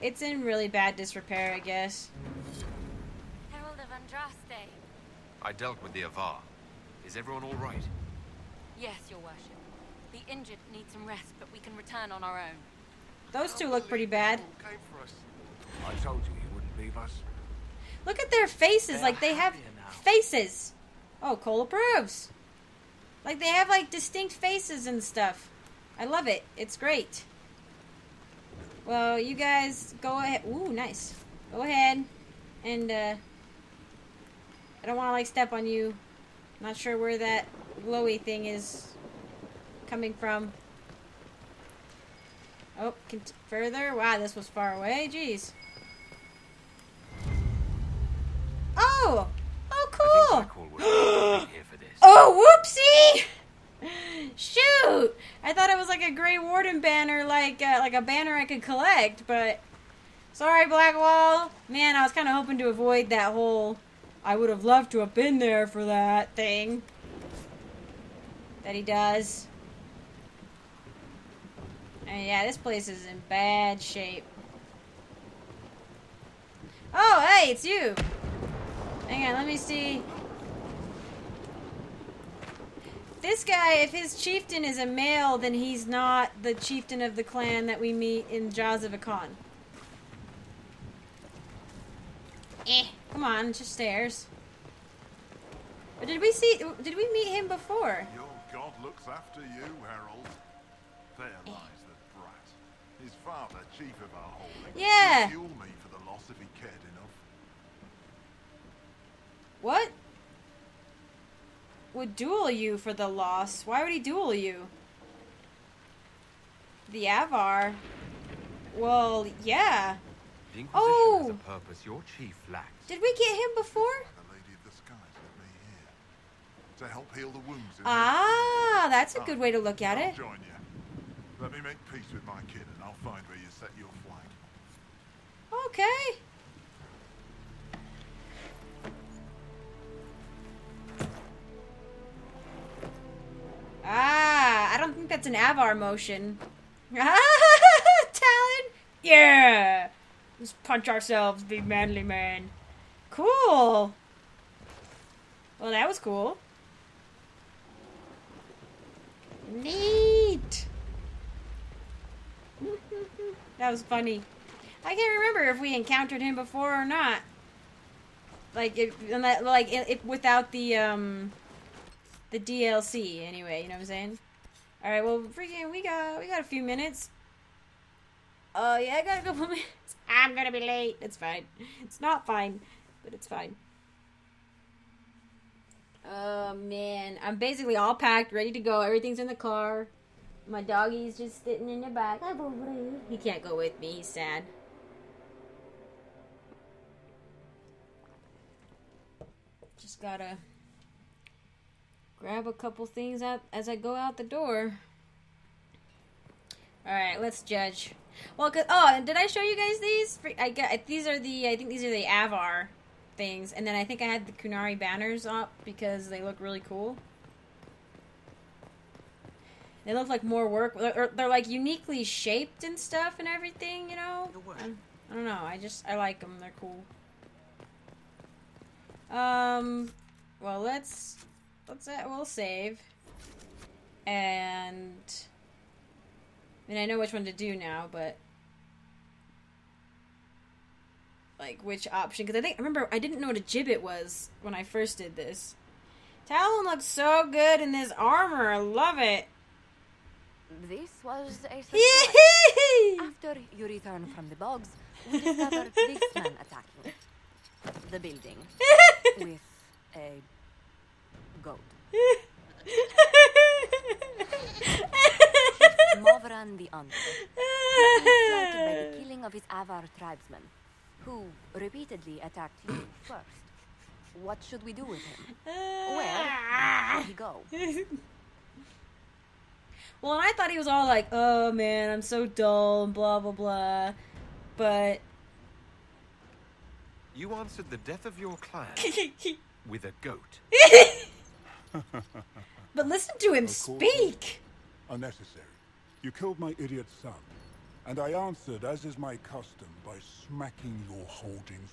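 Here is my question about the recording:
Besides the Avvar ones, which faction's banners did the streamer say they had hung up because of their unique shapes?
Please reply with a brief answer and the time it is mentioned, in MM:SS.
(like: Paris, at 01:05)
Qunari, at 03:34.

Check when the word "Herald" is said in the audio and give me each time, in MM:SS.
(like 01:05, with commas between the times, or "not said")
00:03, 01:39.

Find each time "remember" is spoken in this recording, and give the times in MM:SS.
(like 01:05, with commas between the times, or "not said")
02:45, 04:02.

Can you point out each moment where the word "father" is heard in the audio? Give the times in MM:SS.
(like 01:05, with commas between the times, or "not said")
01:43.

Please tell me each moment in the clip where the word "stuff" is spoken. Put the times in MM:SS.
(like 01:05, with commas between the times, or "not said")
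00:25, 03:42.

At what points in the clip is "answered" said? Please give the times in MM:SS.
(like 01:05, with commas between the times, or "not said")
04:47, 04:58.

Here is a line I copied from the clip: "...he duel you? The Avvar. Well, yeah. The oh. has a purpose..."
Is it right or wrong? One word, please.
right.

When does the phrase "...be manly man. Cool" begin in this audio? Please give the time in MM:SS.
02:31.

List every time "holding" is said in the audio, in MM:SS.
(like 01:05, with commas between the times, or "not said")
01:44, 05:01.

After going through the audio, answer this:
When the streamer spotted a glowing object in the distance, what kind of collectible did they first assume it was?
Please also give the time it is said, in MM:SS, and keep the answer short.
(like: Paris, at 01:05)
Grey Warden banner, at 00:56.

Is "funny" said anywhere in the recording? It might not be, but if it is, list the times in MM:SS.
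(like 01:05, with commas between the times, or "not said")
02:43.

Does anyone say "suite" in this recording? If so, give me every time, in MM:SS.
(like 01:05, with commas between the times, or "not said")
not said.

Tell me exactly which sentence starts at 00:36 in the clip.
Not sure where that glowy thing is coming from.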